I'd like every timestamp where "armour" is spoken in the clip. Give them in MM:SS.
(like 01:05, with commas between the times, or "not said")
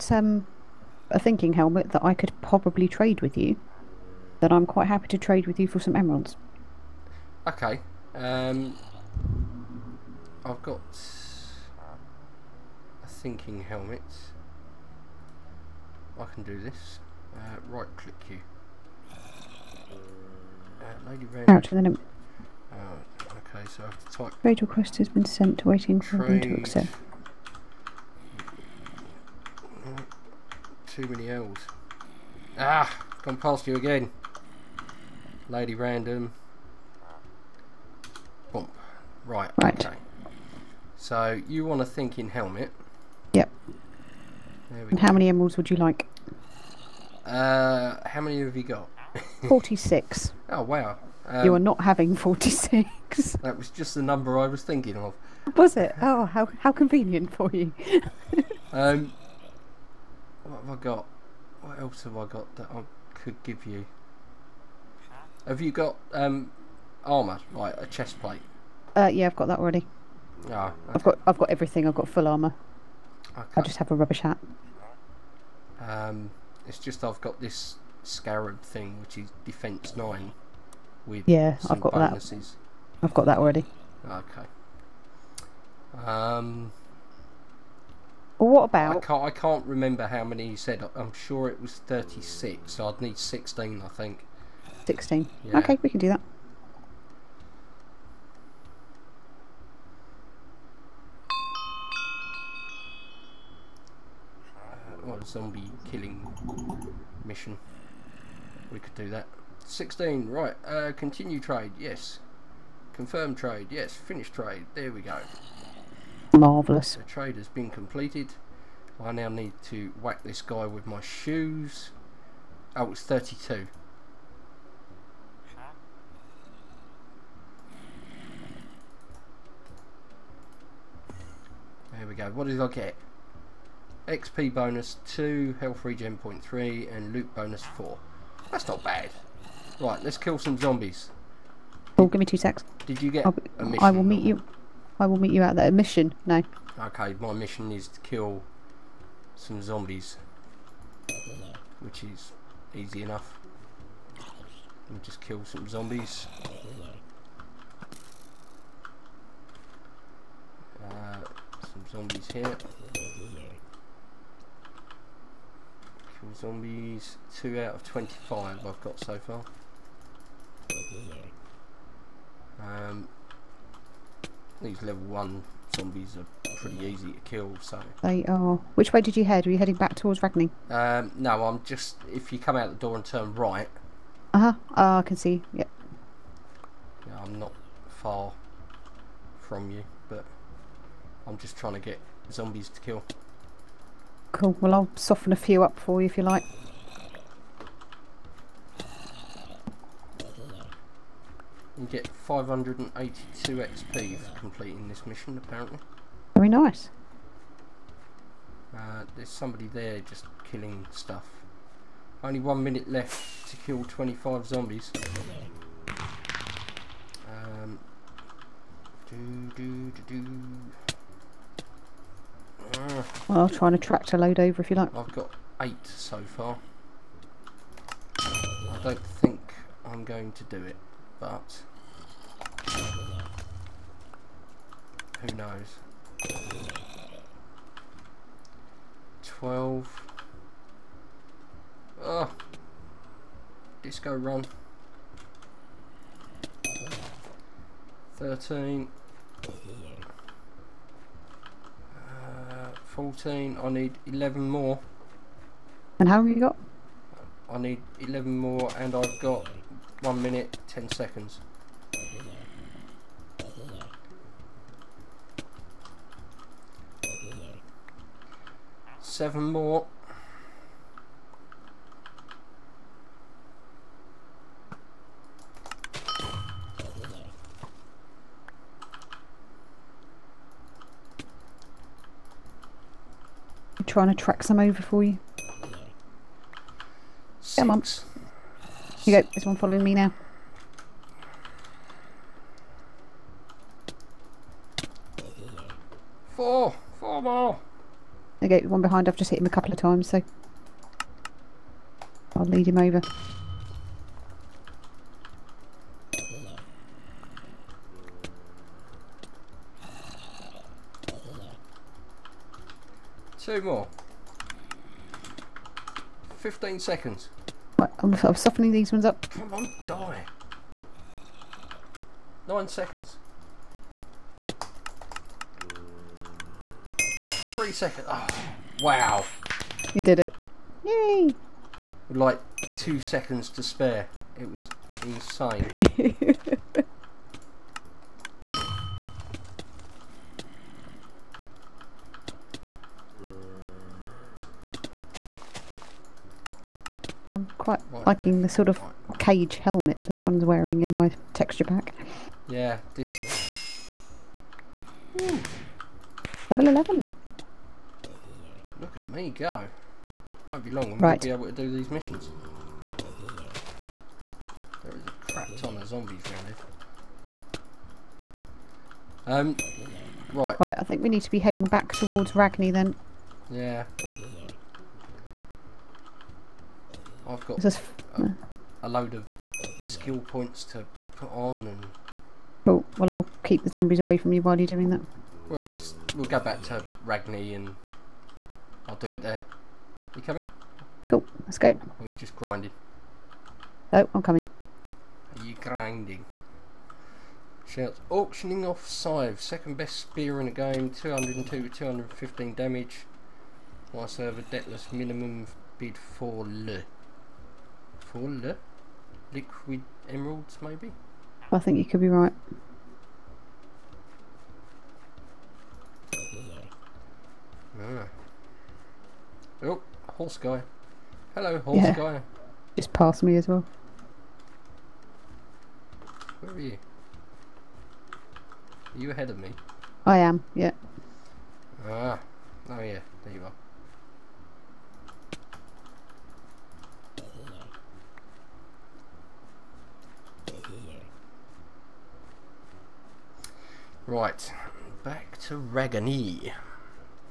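01:07, 01:12.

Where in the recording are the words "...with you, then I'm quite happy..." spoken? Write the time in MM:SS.
00:03.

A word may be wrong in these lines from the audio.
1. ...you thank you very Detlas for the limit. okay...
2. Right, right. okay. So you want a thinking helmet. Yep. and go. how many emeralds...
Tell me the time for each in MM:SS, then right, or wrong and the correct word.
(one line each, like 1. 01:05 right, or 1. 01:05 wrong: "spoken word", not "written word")
1. 00:18 wrong: "Out", not "Detlas"
2. 00:39 right.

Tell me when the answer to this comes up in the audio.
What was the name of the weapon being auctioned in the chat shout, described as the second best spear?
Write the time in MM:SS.
06:38.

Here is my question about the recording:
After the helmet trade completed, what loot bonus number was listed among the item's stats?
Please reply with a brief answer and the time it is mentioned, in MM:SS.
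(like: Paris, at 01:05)
4, at 02:17.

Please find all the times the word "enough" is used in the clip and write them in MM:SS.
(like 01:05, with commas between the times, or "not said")
02:33.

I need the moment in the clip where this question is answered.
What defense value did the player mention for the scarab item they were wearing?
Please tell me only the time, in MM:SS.
01:19.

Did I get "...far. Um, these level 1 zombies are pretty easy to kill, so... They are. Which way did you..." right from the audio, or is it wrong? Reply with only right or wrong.
right.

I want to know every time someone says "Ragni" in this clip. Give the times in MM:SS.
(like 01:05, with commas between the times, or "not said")
03:00, 06:12, 06:27, 07:25.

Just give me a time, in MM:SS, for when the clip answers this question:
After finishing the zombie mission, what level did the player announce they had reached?
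05:56.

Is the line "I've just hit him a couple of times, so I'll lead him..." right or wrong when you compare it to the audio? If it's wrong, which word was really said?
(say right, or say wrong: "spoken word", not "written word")
right.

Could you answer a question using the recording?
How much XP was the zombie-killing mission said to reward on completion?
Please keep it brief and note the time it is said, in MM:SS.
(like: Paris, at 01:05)
582, at 03:22.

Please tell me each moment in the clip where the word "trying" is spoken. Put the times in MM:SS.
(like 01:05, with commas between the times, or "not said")
03:11, 04:43.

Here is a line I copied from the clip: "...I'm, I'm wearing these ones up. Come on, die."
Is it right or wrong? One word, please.
wrong.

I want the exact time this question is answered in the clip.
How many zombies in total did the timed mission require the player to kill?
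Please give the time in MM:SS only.
03:33.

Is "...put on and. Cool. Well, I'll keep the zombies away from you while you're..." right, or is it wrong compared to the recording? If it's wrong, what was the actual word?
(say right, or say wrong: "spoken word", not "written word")
right.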